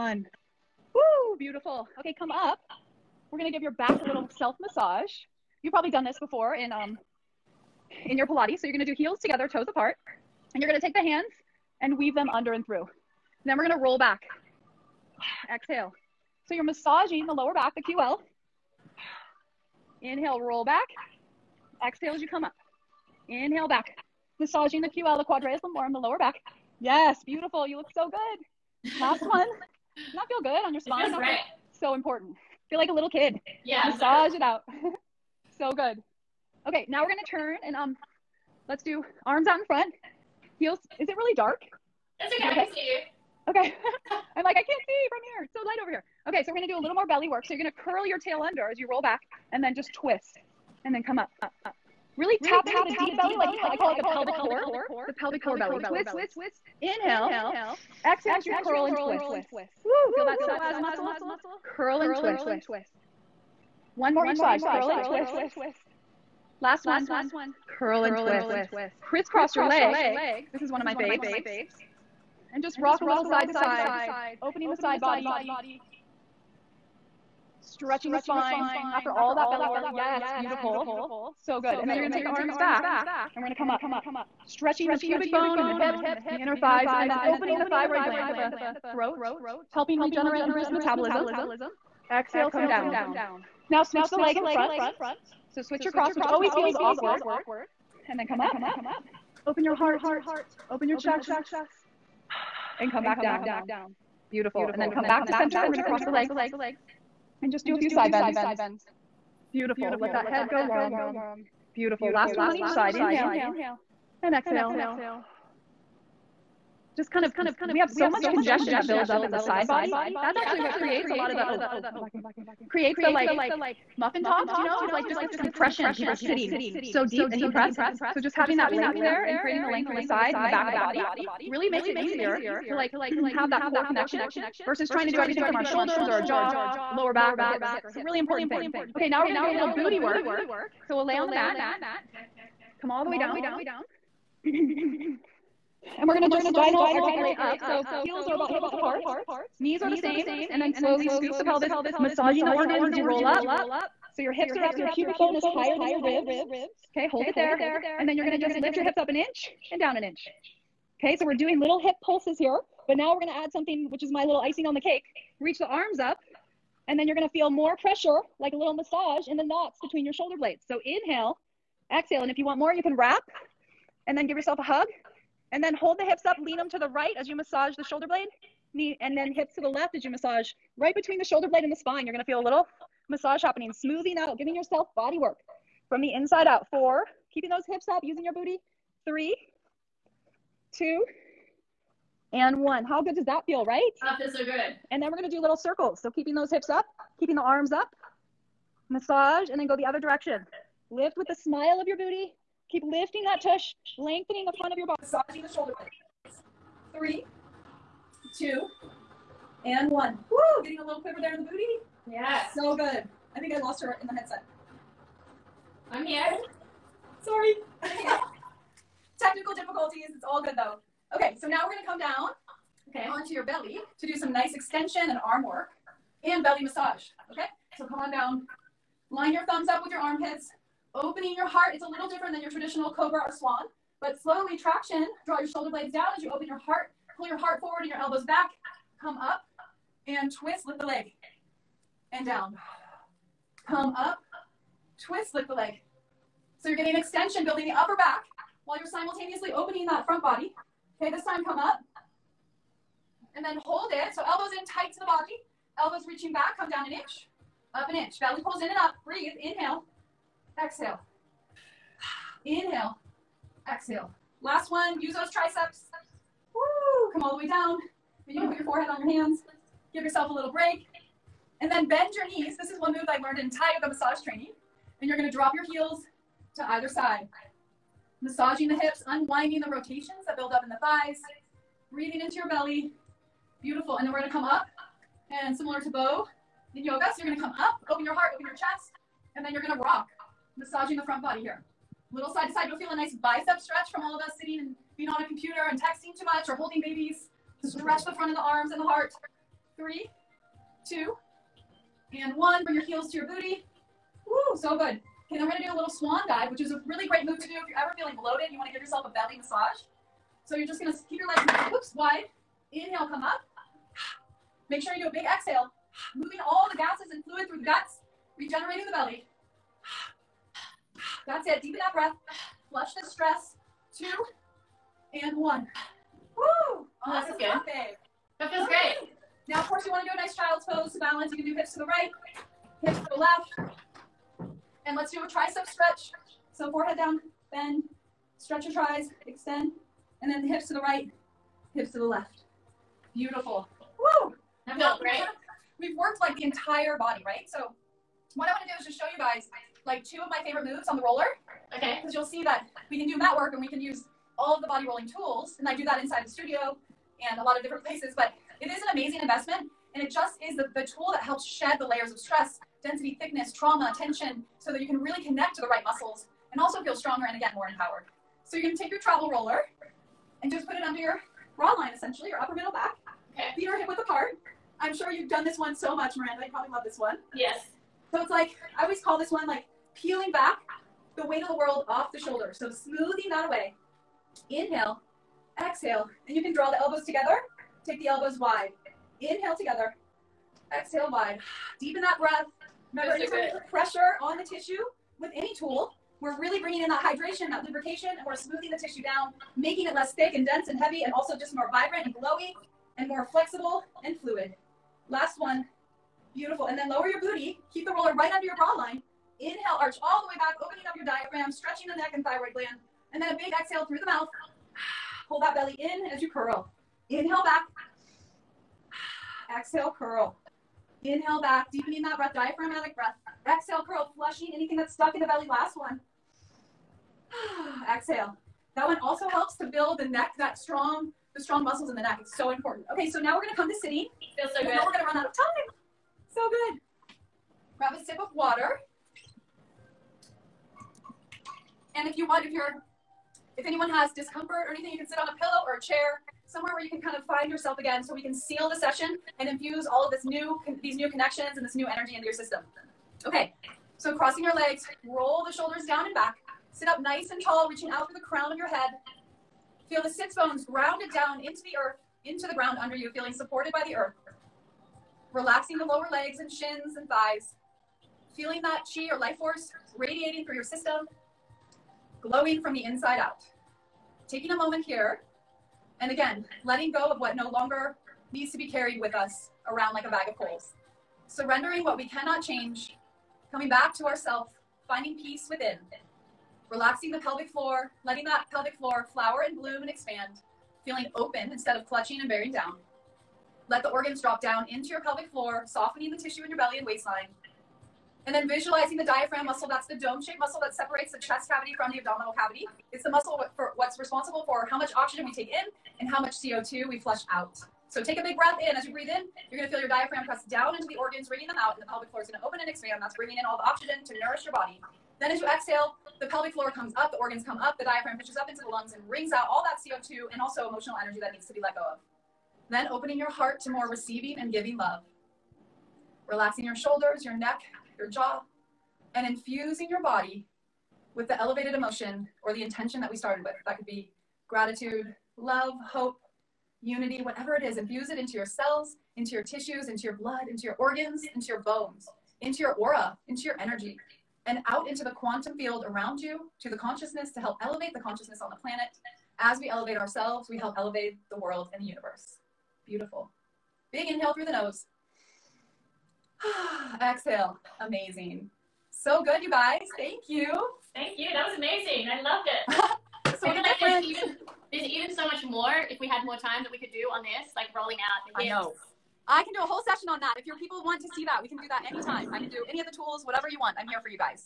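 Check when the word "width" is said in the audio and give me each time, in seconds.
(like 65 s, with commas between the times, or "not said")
148 s, 373 s.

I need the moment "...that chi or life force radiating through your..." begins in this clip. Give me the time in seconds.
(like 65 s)
468 s.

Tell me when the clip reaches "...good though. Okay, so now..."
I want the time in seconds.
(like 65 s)
220 s.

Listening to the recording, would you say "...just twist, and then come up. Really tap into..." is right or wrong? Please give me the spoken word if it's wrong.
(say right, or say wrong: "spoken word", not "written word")
right.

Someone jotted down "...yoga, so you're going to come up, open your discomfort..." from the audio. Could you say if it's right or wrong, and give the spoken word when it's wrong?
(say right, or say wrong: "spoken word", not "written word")
wrong: "heart", not "discomfort".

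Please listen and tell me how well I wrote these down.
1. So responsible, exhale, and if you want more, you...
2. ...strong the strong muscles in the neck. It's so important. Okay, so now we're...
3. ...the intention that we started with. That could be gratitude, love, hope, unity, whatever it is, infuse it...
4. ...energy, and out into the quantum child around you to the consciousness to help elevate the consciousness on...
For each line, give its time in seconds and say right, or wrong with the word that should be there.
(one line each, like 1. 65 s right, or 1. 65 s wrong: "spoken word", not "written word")
1. 170 s wrong: "inhale", not "responsible"
2. 430 s right
3. 532 s right
4. 543 s wrong: "field", not "child".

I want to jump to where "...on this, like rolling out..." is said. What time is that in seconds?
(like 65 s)
567 s.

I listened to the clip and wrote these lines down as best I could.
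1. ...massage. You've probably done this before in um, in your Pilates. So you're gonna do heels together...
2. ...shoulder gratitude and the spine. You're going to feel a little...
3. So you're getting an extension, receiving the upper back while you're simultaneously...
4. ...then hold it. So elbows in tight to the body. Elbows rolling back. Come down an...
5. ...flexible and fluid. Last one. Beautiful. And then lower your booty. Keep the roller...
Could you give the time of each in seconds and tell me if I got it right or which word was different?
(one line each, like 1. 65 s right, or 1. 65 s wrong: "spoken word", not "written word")
1. 4 s right
2. 181 s wrong: "blade", not "gratitude"
3. 246 s wrong: "building", not "receiving"
4. 253 s wrong: "reaching", not "rolling"
5. 403 s right.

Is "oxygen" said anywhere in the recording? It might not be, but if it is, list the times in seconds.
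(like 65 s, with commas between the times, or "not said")
504 s, 513 s.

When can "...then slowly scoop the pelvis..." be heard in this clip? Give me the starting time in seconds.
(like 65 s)
150 s.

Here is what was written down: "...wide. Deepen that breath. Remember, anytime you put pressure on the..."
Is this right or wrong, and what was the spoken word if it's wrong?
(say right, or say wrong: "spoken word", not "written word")
right.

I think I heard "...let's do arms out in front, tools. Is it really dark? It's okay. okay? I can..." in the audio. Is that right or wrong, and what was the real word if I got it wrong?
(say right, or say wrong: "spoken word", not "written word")
wrong: "heels", not "tools".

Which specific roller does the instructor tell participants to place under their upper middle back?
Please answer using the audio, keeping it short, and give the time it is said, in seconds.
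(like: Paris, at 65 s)
travel roller, at 368 s.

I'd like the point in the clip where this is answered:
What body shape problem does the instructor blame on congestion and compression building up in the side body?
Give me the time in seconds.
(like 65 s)
123 s.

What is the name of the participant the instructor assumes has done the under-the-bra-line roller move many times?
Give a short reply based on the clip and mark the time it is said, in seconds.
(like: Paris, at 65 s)
Miranda, at 376 s.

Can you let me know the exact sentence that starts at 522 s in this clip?
Then opening your heart to more receiving and giving love.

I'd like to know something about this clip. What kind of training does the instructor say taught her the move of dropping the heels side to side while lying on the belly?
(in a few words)
Thai yoga massage.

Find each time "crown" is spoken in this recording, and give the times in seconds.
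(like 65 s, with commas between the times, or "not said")
458 s.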